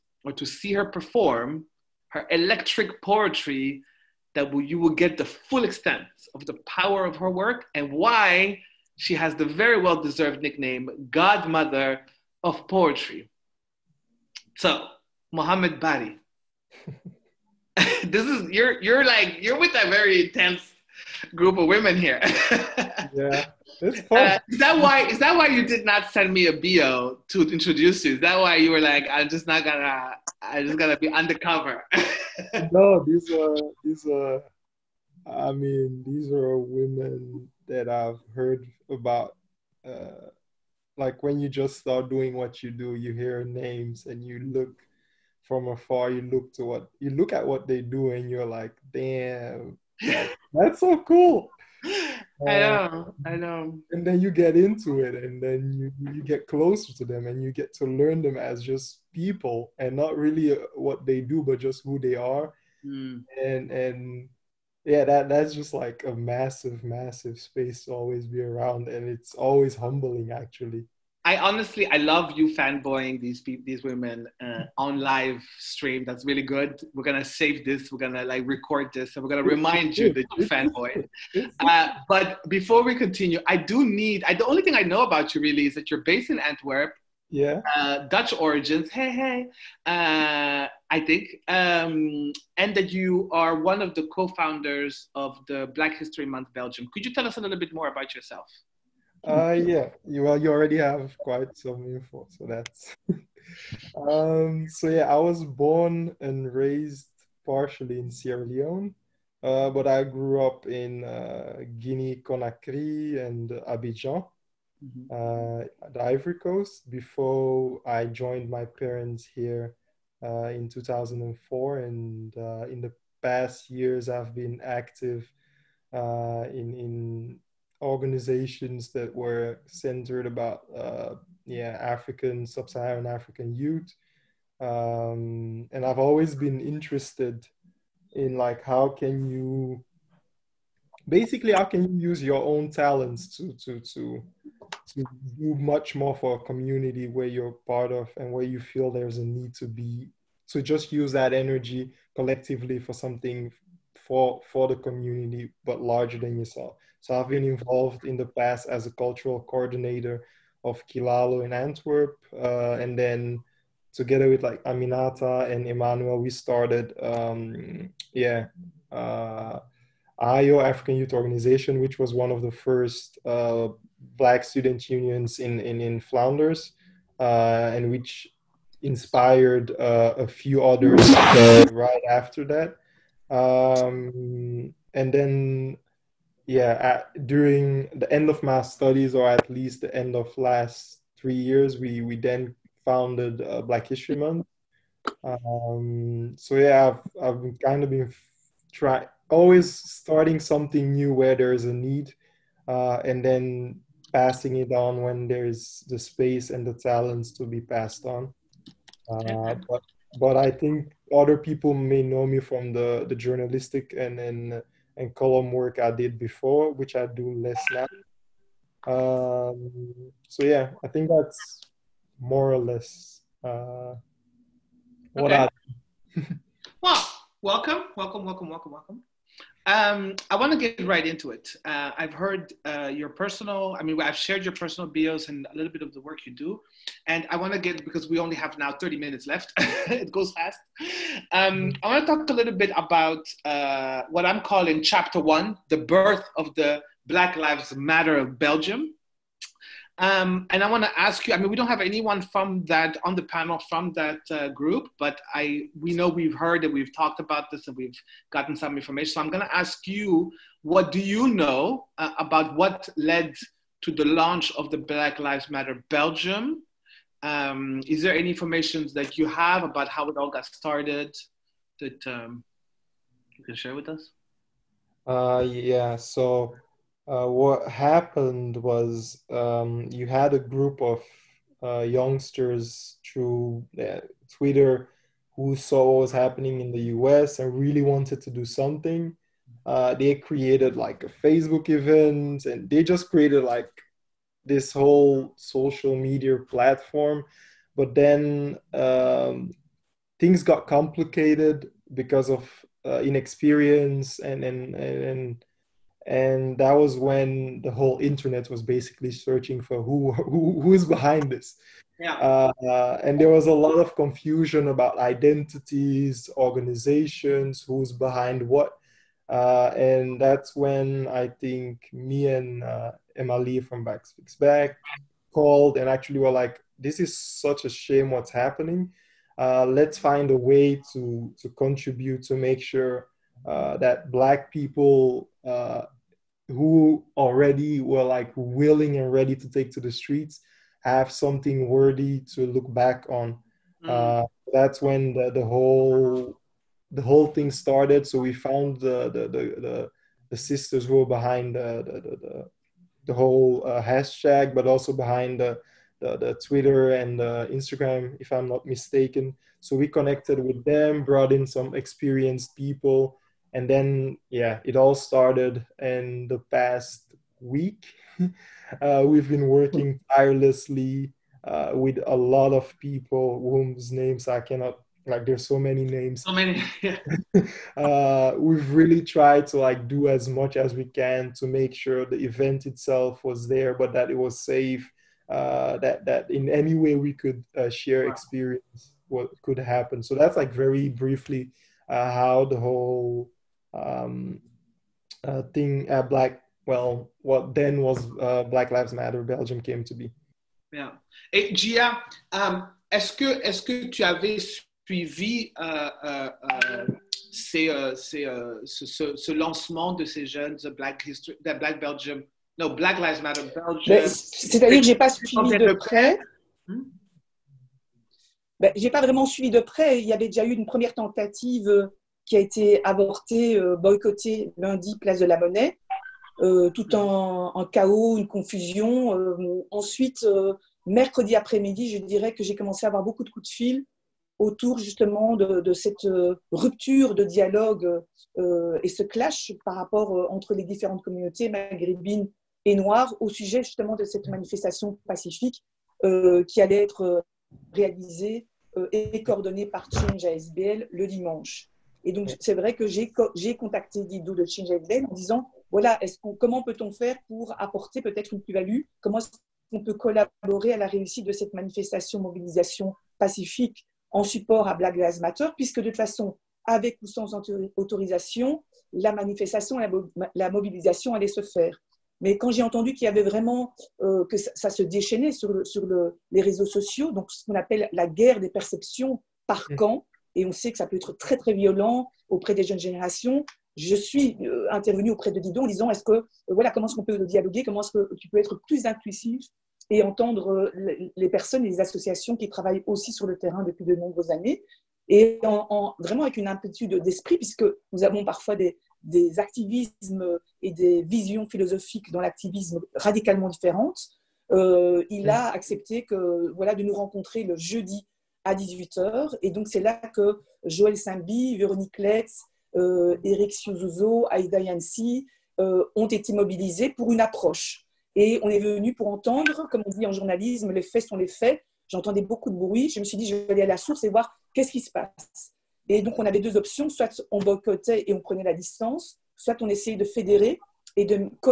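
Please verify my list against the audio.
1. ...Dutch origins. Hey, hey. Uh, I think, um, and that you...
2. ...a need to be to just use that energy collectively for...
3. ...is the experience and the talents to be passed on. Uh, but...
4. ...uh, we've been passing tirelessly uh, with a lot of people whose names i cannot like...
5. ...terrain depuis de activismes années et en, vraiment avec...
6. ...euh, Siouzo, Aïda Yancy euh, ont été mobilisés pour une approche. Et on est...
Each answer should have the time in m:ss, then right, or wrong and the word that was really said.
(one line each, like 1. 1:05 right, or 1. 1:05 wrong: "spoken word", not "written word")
1. 1:28 right
2. 2:29 right
3. 3:25 wrong: "space", not "experience"
4. 6:08 wrong: "working", not "passing"
5. 8:13 wrong: "nombreuses", not "activismes"
6. 8:33 right.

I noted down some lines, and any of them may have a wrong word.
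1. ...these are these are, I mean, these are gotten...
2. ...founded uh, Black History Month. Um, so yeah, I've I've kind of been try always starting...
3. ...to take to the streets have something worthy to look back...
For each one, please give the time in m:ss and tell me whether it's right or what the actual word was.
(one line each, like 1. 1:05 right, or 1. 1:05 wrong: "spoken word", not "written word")
1. 0:33 wrong: "women", not "gotten"
2. 3:12 right
3. 5:39 right.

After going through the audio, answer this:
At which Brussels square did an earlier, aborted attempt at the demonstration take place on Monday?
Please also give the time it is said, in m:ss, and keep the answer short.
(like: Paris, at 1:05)
Place de la Monnaie, at 7:04.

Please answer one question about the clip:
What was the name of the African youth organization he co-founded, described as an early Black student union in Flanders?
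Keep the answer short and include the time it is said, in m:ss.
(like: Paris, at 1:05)
Ayo African Youth Organization, at 2:50.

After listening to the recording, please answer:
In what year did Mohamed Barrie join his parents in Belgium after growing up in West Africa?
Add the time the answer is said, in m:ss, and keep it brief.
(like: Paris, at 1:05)
2004, at 2:00.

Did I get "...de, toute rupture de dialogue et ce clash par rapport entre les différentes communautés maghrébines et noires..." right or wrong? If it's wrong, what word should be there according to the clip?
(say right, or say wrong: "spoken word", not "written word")
wrong: "cette", not "toute".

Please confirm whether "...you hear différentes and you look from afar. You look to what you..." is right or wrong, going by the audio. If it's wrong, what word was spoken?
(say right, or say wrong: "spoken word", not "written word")
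wrong: "names", not "différentes".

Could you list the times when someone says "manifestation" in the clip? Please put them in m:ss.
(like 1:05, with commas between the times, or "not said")
7:24, 7:41, 7:49.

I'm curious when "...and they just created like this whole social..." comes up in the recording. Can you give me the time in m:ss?
4:52.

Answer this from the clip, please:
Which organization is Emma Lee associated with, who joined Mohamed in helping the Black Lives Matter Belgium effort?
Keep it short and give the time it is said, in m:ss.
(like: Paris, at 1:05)
Black Speaks Back, at 5:23.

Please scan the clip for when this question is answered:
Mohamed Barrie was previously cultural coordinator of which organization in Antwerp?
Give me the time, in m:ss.
2:40.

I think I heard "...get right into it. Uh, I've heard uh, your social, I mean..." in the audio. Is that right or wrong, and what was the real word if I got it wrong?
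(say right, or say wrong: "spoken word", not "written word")
wrong: "personal", not "social".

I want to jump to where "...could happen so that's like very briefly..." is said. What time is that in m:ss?
6:29.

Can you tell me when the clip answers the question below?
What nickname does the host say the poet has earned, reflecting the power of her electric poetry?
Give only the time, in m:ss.
0:11.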